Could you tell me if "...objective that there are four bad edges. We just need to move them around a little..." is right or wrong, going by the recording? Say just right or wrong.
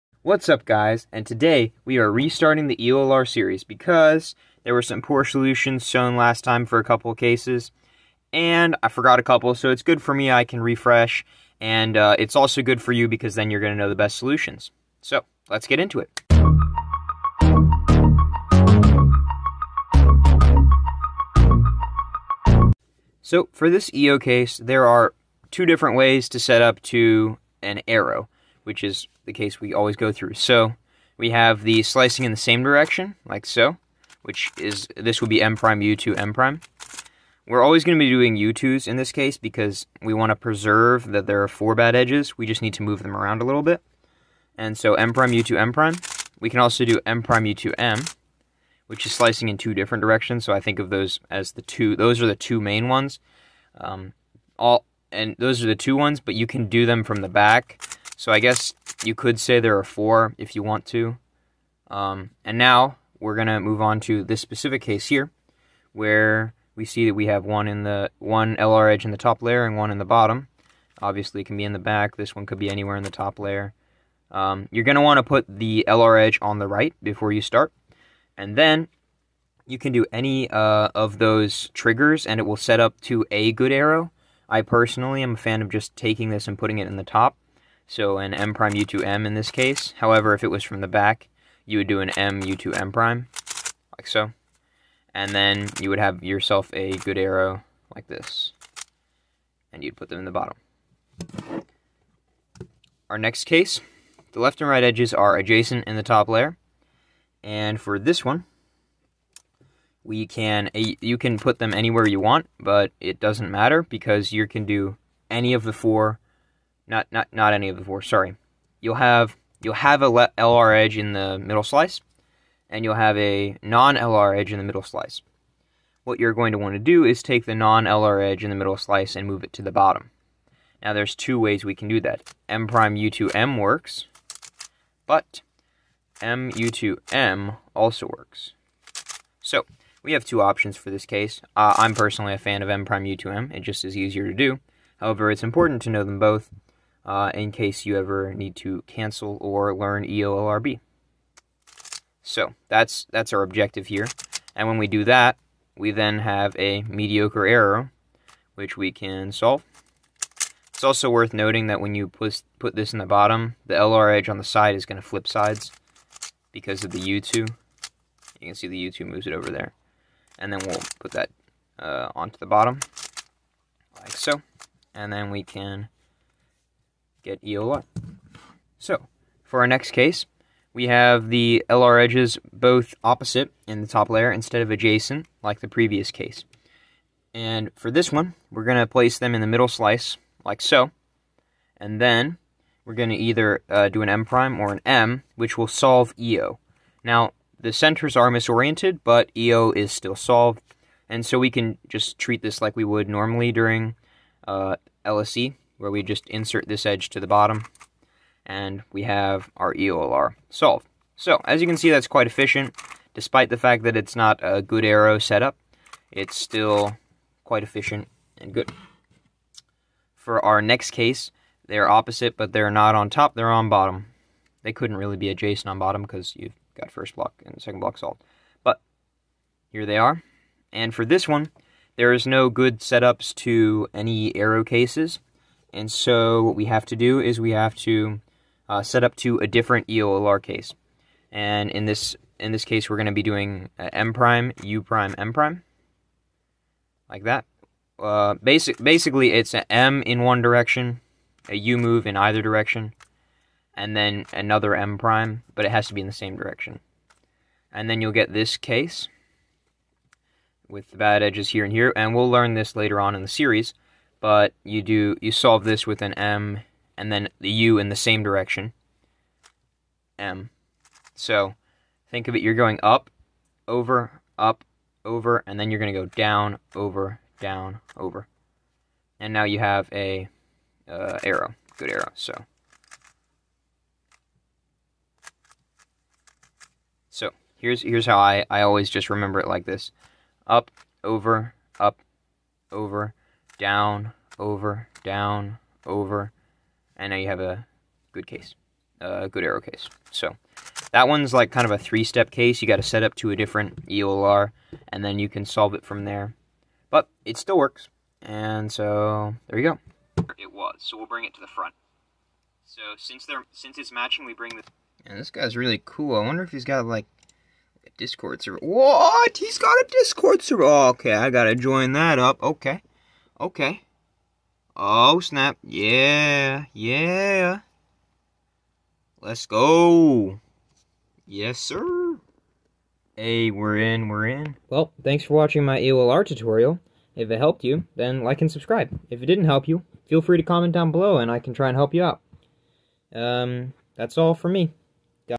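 wrong.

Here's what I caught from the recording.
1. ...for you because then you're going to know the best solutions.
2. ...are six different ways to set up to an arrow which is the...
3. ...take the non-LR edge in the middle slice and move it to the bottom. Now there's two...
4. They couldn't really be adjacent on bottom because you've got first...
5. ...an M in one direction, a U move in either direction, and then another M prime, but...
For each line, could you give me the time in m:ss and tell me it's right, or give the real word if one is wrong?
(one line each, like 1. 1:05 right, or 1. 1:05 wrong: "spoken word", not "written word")
1. 0:12 right
2. 0:24 wrong: "two", not "six"
3. 2:07 right
4. 3:44 right
5. 4:09 right.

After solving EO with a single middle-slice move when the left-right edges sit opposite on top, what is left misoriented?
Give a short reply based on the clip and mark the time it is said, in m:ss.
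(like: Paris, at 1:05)
The centers, at 3:17.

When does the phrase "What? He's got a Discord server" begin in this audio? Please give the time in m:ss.
5:18.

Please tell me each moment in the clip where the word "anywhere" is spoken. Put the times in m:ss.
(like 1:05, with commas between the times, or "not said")
1:12, 1:51.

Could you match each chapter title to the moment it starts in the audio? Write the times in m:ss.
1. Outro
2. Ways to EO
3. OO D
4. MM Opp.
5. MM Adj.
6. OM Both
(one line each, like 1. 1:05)
1. 5:10
2. 0:22
3. 3:38
4. 2:57
5. 1:40
6. 1:05.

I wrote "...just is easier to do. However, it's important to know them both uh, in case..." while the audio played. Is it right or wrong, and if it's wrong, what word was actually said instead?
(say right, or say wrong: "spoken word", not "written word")
right.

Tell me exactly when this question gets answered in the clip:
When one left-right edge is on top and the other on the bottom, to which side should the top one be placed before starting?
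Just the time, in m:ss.
1:15.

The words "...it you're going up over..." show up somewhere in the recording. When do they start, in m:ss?
4:32.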